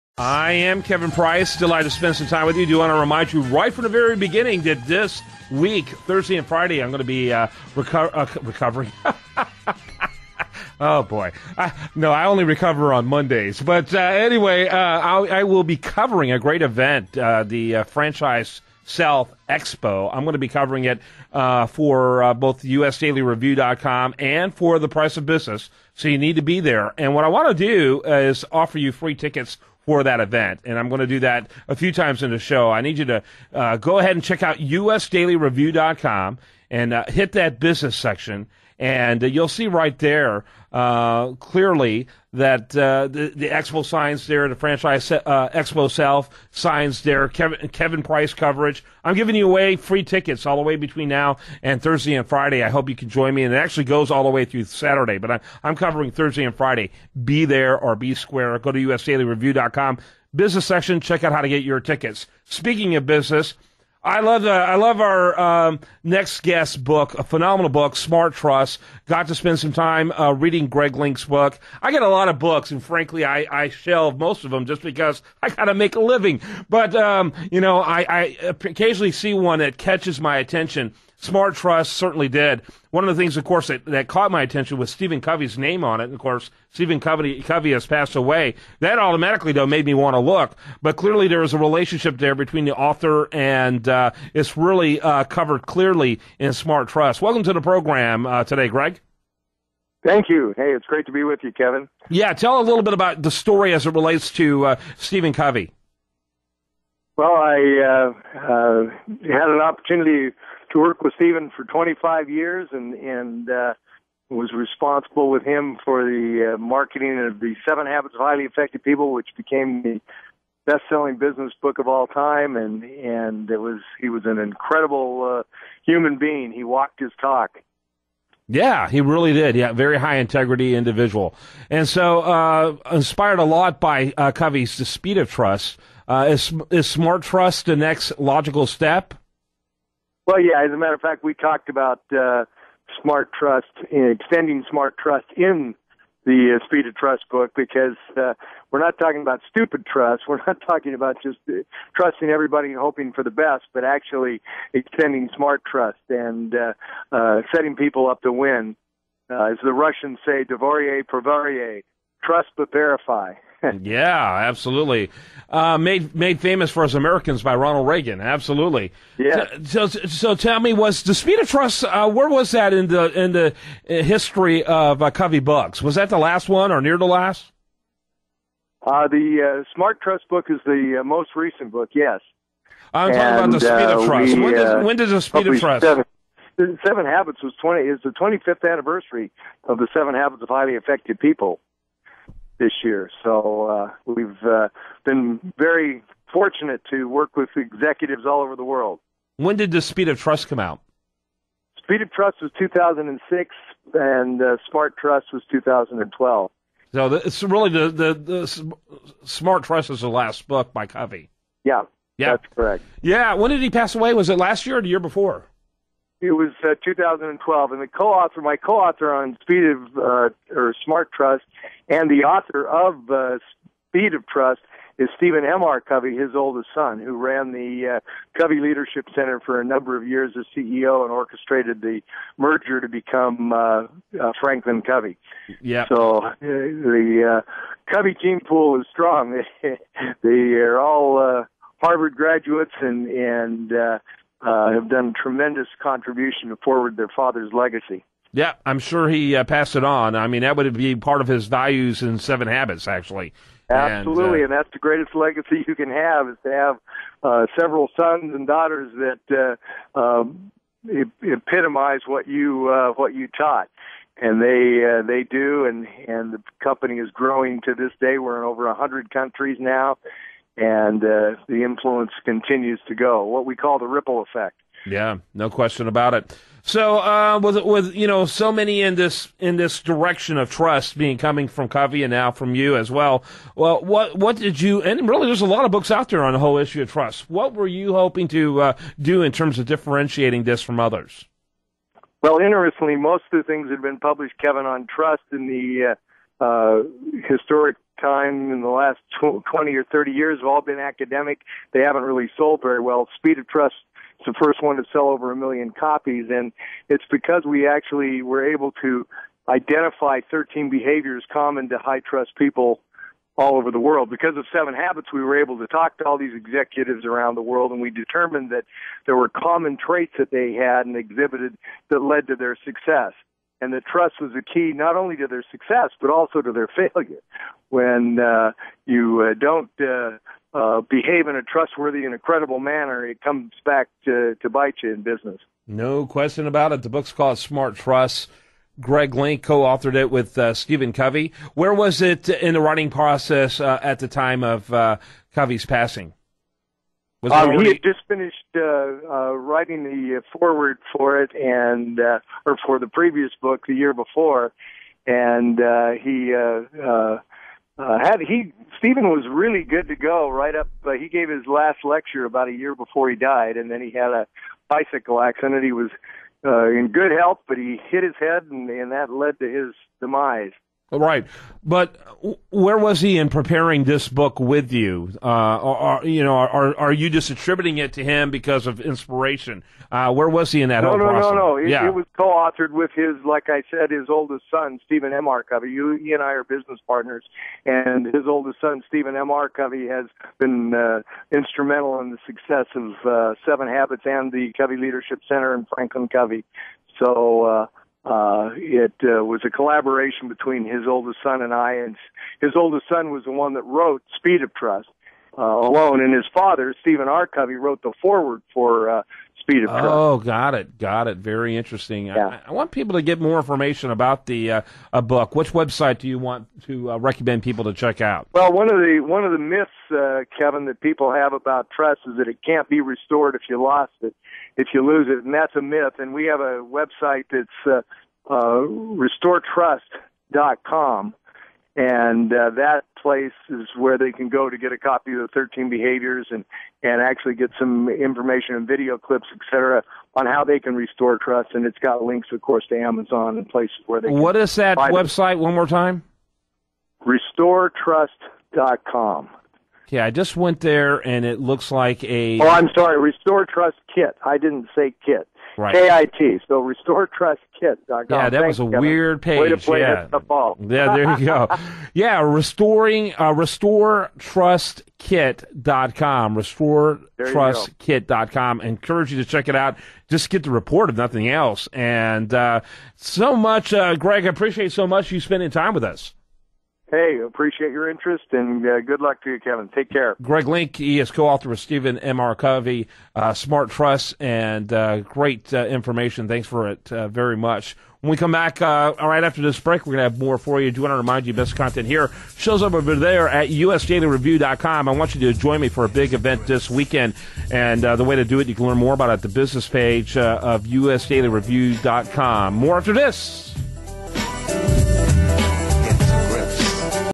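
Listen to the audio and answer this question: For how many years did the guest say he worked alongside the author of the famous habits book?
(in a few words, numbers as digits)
25.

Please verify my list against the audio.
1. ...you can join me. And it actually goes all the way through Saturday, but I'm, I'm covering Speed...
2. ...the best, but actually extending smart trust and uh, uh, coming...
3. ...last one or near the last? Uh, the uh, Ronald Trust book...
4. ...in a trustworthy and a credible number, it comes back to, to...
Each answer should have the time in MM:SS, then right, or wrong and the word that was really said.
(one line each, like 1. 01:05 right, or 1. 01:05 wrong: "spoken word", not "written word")
1. 00:52 wrong: "Thursday", not "Speed"
2. 02:33 wrong: "setting", not "coming"
3. 02:56 wrong: "Smart", not "Ronald"
4. 05:31 wrong: "manner", not "number".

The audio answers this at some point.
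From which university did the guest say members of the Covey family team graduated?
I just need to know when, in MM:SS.
04:01.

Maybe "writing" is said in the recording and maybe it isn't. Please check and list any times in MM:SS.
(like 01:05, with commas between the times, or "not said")
05:42, 05:49.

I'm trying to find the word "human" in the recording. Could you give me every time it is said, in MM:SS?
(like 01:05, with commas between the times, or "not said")
02:05.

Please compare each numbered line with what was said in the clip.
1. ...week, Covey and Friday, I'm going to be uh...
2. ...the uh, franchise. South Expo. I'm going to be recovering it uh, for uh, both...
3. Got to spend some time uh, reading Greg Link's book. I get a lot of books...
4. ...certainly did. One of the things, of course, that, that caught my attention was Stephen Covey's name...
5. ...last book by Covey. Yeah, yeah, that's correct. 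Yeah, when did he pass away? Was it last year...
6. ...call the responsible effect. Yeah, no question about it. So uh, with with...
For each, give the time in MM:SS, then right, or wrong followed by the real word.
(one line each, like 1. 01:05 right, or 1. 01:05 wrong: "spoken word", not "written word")
1. 00:05 wrong: "Thursday", not "Covey"
2. 00:17 wrong: "covering", not "recovering"
3. 01:09 right
4. 01:21 right
5. 03:30 right
6. 04:33 wrong: "ripple", not "responsible".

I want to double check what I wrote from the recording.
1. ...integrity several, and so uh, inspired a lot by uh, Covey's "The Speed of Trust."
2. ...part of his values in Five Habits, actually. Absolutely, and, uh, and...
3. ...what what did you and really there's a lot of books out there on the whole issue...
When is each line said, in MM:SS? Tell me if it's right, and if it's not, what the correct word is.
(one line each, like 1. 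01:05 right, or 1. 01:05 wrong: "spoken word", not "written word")
1. 02:10 wrong: "individual", not "several"
2. 04:10 wrong: "Seven", not "Five"
3. 04:43 right.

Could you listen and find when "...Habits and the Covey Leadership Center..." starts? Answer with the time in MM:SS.
06:33.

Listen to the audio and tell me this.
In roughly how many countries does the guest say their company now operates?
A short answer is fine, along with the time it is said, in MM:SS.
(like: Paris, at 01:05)
over 100, at 04:28.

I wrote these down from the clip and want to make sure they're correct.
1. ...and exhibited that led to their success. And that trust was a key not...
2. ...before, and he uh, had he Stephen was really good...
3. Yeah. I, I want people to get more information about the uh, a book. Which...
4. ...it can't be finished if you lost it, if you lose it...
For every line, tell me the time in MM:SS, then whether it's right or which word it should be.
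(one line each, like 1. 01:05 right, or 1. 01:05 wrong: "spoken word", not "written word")
1. 05:20 right
2. 05:53 right
3. 06:52 right
4. 07:02 wrong: "restored", not "finished".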